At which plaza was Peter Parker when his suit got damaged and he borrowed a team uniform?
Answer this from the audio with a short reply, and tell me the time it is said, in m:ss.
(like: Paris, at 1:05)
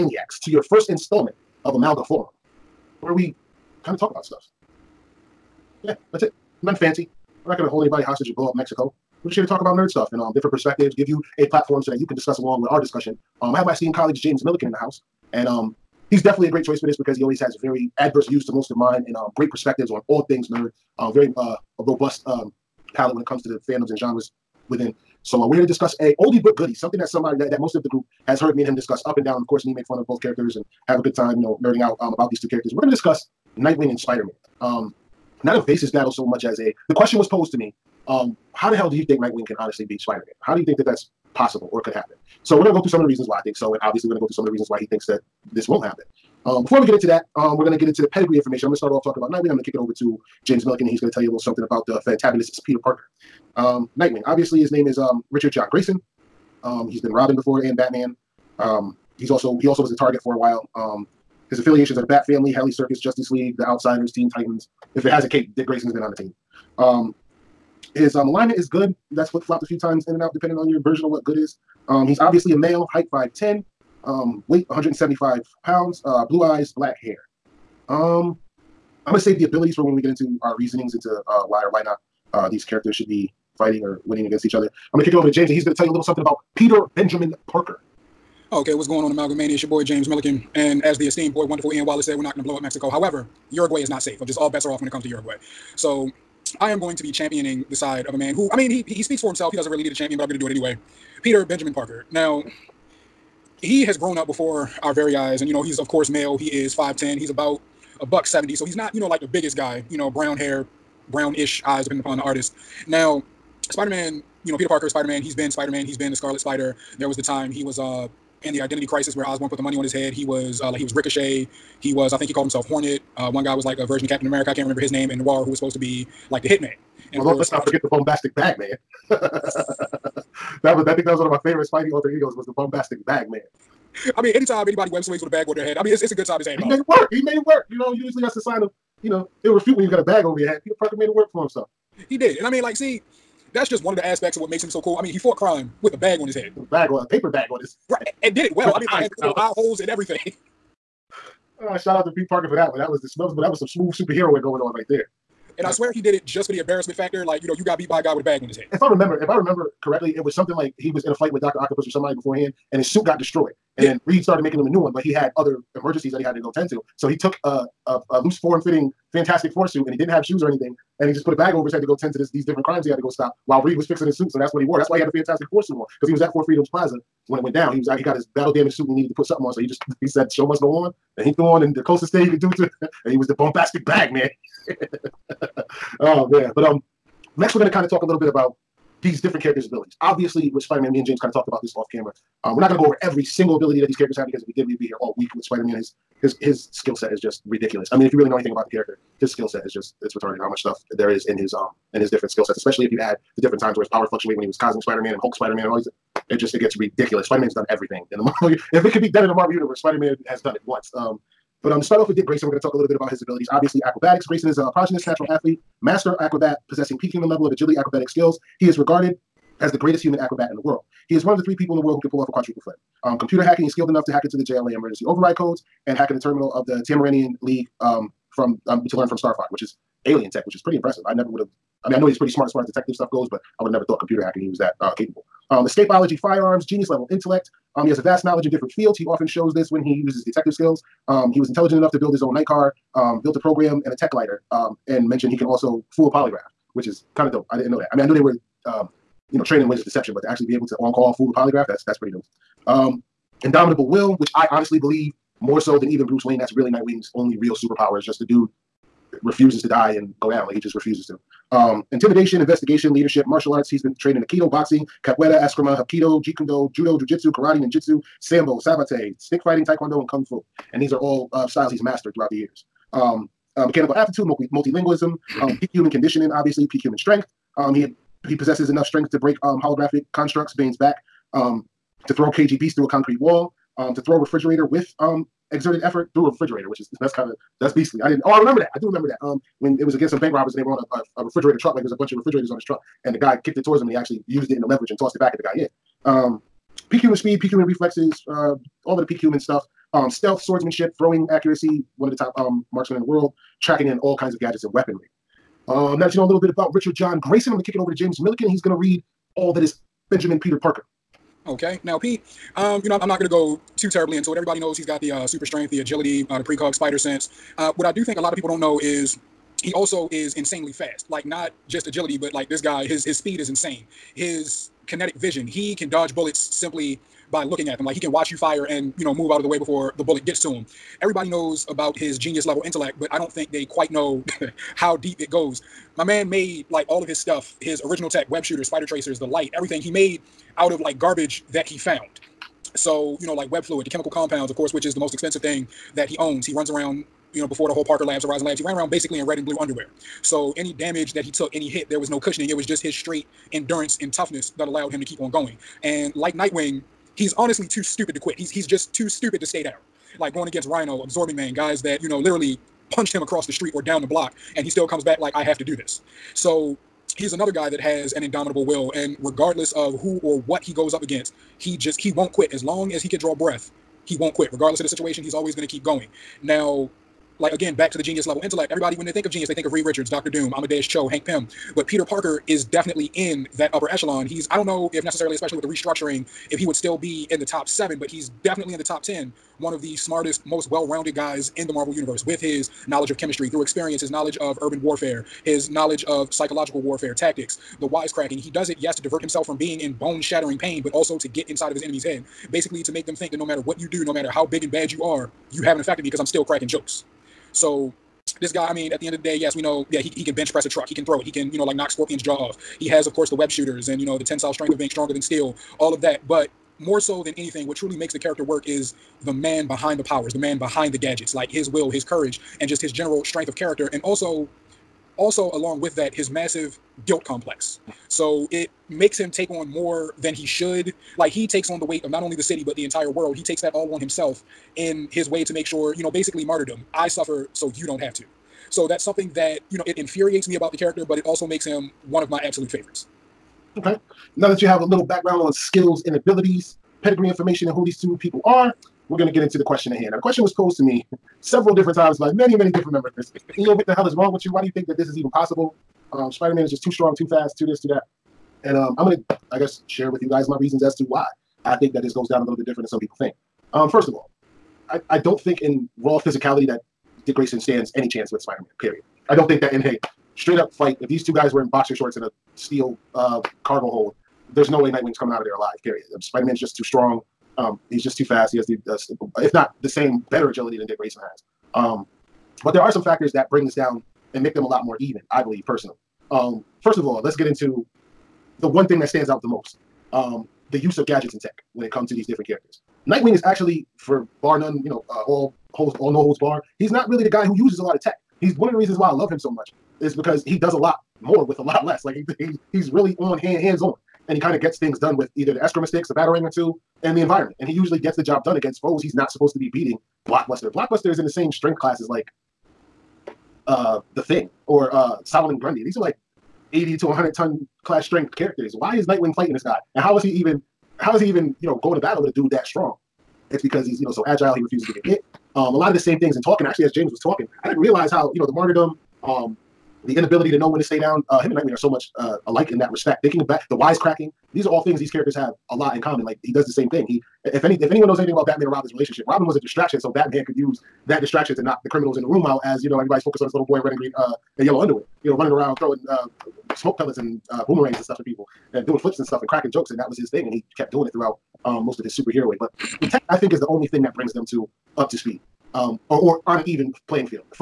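Four Freedoms Plaza, at 2:56.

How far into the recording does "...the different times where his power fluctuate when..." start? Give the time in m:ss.
3:23.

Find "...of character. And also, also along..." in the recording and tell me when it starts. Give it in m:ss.
7:03.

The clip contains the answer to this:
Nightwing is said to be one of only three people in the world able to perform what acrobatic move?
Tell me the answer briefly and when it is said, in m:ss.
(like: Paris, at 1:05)
quadruple flip, at 3:42.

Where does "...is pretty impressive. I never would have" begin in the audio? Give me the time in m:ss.
3:50.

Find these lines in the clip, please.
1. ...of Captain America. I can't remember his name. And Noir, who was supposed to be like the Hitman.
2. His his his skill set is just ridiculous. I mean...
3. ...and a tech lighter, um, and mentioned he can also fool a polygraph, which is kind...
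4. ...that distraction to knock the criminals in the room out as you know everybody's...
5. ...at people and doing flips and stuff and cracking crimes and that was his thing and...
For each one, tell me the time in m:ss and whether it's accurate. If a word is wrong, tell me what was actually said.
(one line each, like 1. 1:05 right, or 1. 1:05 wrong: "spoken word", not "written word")
1. 2:04 right
2. 3:15 right
3. 4:03 right
4. 9:01 right
5. 9:08 wrong: "jokes", not "crimes".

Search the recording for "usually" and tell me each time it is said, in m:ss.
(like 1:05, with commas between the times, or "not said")
2:17, 8:27.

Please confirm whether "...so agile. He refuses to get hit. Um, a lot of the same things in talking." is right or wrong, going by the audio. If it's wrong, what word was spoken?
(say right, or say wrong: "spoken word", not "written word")
right.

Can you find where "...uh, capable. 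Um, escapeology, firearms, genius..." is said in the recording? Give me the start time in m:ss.
3:54.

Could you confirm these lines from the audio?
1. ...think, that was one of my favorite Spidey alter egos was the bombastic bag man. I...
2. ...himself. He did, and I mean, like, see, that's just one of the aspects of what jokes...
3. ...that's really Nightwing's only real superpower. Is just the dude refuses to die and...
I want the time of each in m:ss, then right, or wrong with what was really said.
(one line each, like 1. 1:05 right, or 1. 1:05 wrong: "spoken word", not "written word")
1. 2:10 right
2. 2:21 wrong: "makes", not "jokes"
3. 4:16 right.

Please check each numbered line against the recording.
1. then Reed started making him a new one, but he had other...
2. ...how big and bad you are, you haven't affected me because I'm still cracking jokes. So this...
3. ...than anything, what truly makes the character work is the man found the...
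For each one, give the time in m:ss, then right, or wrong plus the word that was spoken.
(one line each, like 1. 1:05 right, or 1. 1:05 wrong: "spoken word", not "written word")
1. 2:43 right
2. 6:44 right
3. 6:57 wrong: "behind", not "found".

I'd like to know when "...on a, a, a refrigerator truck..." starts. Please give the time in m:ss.
4:50.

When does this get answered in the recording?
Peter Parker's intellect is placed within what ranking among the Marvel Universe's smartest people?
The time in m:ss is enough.
6:28.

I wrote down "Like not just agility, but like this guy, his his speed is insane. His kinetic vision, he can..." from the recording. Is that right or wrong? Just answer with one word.
right.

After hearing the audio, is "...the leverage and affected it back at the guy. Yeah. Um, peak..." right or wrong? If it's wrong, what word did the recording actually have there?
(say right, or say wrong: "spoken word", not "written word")
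wrong: "tossed", not "affected".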